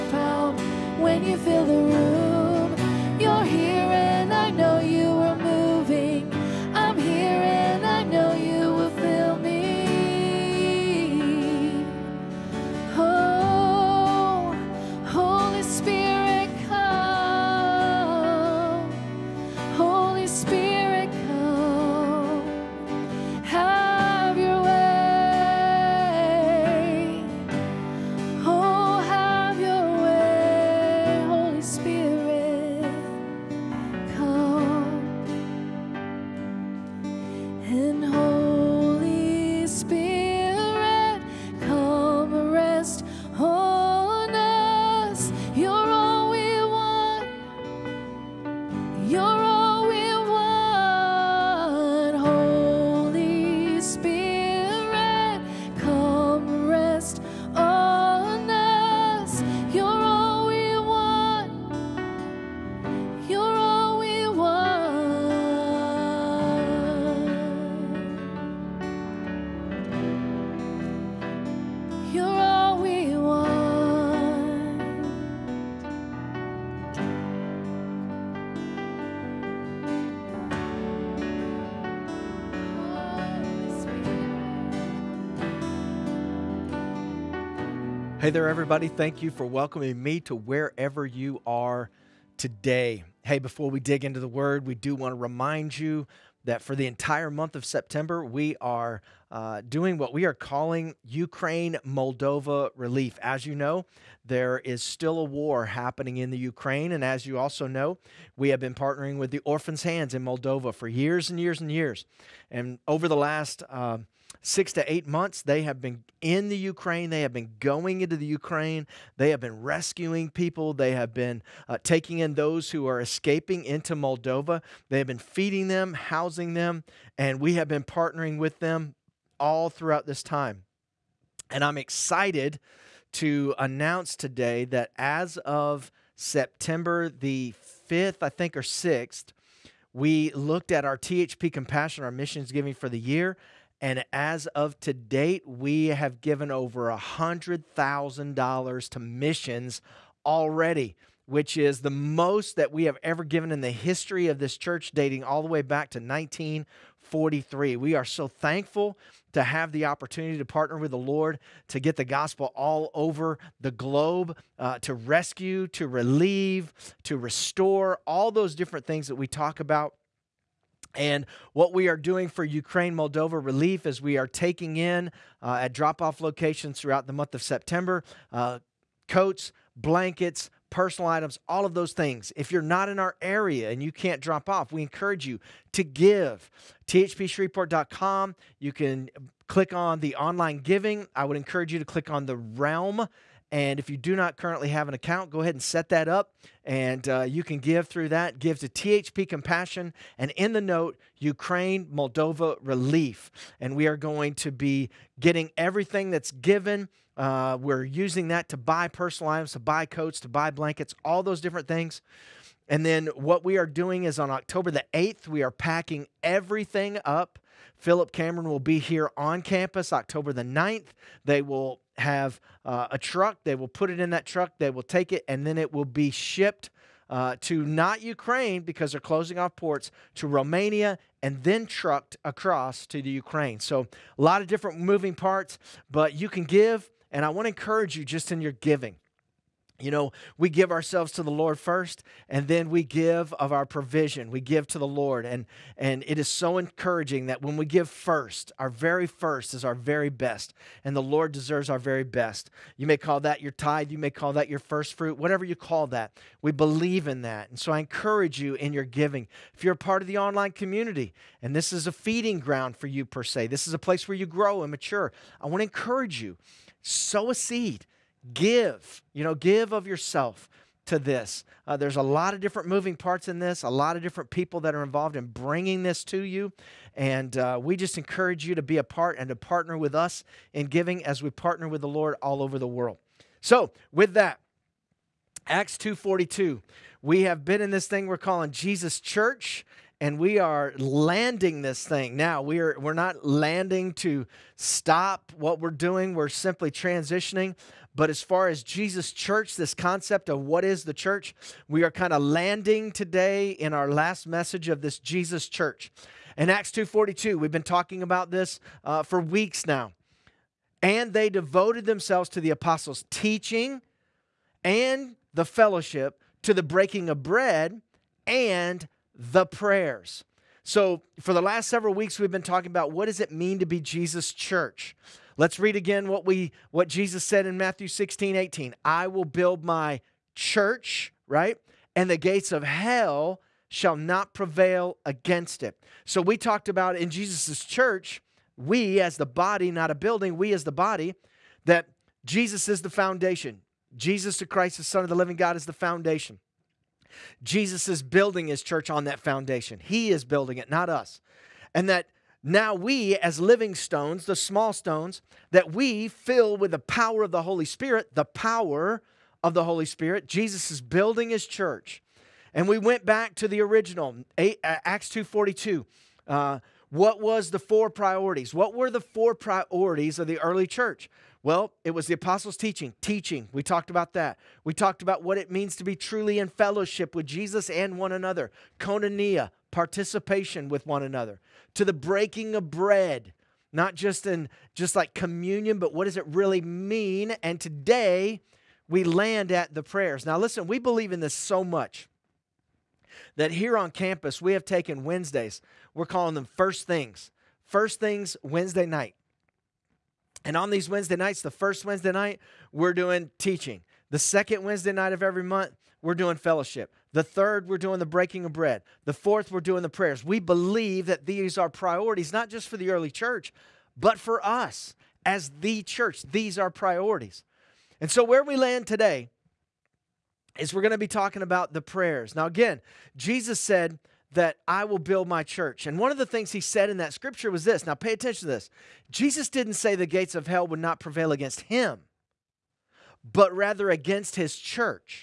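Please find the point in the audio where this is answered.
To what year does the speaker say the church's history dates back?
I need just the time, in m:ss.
2:35.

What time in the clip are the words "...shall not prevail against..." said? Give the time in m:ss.
5:33.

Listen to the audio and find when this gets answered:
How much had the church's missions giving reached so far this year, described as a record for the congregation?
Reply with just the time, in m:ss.
2:26.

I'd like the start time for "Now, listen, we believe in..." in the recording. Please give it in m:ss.
6:30.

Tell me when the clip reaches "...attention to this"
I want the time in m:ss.
7:08.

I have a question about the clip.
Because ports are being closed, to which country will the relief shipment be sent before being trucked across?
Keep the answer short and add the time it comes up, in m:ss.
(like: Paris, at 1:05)
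Romania, at 3:50.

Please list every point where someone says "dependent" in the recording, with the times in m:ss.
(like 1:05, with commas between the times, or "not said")
not said.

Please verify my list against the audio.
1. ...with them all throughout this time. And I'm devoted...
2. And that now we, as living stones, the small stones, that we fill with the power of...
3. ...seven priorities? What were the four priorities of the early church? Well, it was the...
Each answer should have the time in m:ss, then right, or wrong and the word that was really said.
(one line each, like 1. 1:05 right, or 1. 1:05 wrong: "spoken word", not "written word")
1. 2:08 wrong: "excited", not "devoted"
2. 5:51 right
3. 6:07 wrong: "four", not "seven".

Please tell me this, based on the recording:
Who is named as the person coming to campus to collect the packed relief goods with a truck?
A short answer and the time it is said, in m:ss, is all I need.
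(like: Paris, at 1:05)
Philip Cameron, at 3:37.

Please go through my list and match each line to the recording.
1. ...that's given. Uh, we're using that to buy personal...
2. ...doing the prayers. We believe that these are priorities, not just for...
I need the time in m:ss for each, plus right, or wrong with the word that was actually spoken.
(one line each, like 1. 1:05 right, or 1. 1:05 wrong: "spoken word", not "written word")
1. 3:26 right
2. 6:49 right.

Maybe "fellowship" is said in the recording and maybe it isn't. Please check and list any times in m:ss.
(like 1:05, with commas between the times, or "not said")
5:15, 6:16, 6:46.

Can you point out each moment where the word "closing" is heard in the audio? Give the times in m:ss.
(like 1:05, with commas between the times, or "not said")
3:49.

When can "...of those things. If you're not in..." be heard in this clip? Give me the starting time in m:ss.
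3:01.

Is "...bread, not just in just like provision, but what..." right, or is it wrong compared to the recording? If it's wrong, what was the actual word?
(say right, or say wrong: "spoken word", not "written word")
wrong: "communion", not "provision".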